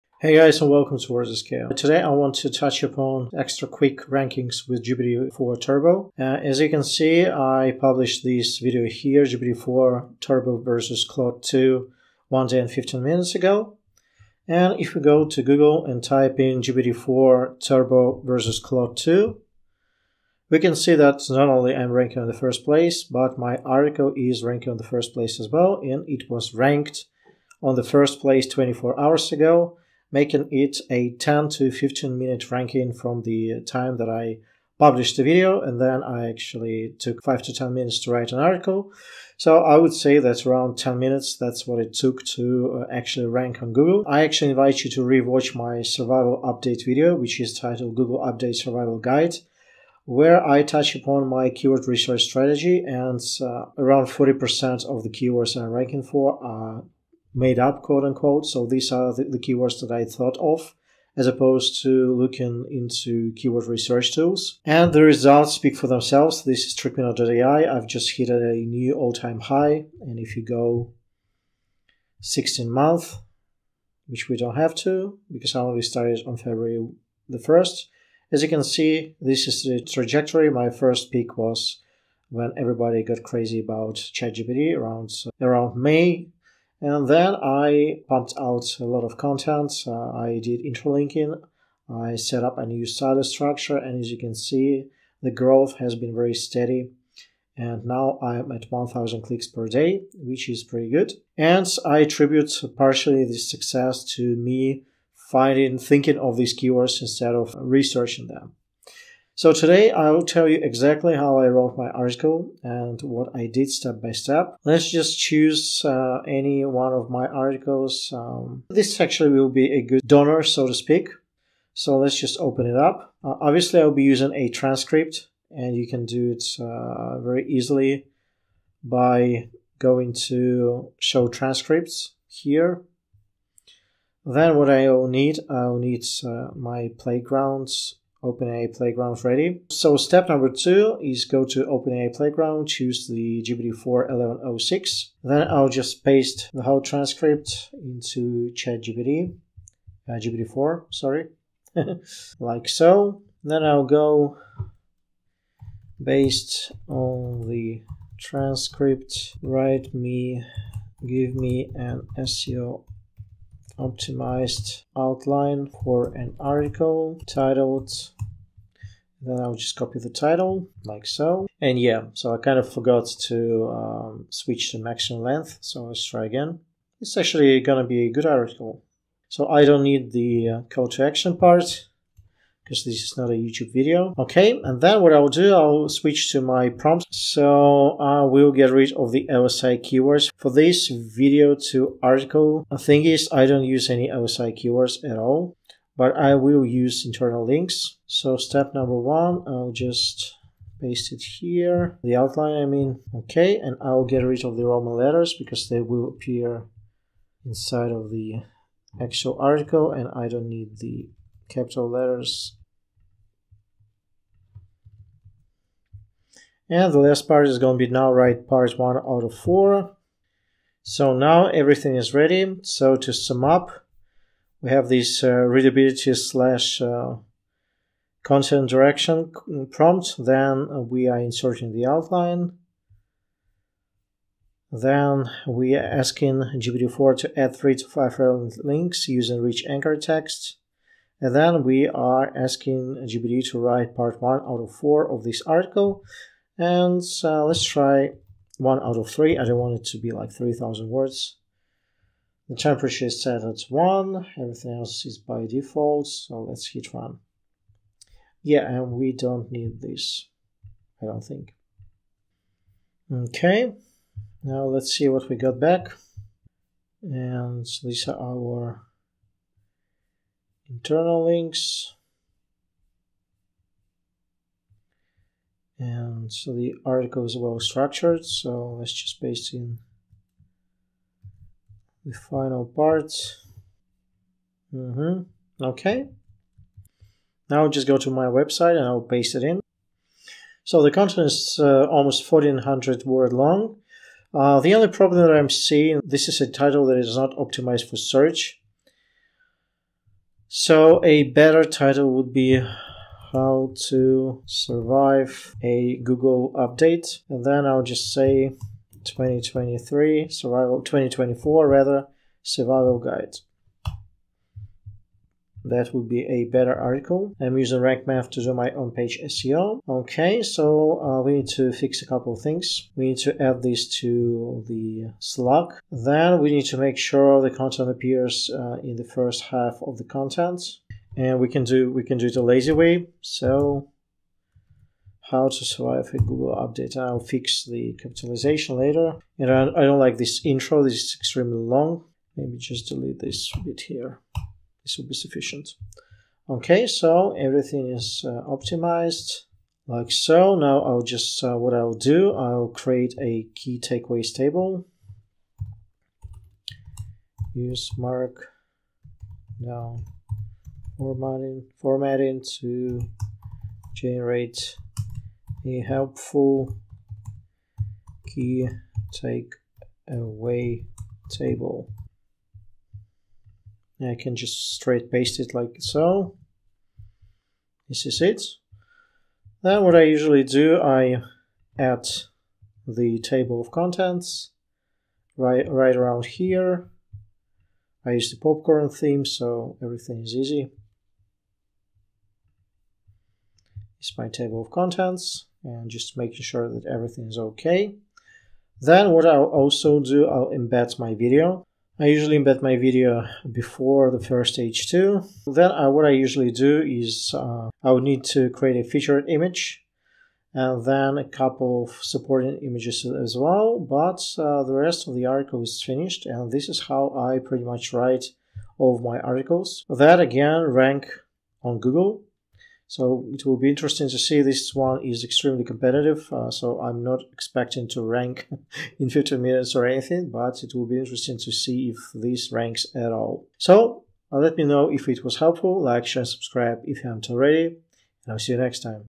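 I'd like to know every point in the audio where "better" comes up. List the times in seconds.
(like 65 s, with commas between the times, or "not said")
301 s, 316 s.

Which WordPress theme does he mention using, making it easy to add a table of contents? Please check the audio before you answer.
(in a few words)
Popcorn.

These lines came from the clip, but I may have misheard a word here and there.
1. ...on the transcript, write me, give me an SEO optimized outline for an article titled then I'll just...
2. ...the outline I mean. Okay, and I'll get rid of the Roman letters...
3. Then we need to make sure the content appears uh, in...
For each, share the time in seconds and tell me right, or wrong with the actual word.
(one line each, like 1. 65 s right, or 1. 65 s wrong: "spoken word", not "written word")
1. 156 s right
2. 202 s right
3. 325 s right.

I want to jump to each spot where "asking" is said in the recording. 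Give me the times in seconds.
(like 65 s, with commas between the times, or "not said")
235 s, 242 s.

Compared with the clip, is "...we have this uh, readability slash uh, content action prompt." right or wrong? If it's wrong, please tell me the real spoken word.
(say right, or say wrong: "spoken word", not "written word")
wrong: "direction", not "action".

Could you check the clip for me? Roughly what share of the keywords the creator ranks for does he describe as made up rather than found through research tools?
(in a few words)
40%.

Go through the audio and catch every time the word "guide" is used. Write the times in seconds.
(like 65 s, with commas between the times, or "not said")
48 s, 312 s.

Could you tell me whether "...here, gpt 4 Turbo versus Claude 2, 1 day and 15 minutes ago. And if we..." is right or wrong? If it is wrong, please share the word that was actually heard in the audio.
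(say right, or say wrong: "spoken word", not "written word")
right.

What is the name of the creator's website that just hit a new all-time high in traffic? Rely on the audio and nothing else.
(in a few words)
Trickminer.ai.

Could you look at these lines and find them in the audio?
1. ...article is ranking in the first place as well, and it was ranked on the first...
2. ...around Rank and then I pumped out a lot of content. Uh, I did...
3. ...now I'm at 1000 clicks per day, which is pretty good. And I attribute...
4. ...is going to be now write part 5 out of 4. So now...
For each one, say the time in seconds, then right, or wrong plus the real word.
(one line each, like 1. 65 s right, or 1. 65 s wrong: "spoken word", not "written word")
1. 23 s right
2. 85 s wrong: "May", not "Rank"
3. 97 s right
4. 217 s wrong: "1", not "5".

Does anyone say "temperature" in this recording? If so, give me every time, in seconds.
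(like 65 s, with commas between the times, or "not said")
252 s.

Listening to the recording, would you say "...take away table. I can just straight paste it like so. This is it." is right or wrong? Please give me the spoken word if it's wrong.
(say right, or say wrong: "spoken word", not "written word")
right.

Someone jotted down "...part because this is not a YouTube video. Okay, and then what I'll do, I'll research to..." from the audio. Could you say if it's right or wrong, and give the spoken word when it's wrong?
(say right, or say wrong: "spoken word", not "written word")
wrong: "switch", not "research".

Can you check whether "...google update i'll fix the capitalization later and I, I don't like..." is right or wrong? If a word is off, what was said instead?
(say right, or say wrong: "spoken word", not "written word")
right.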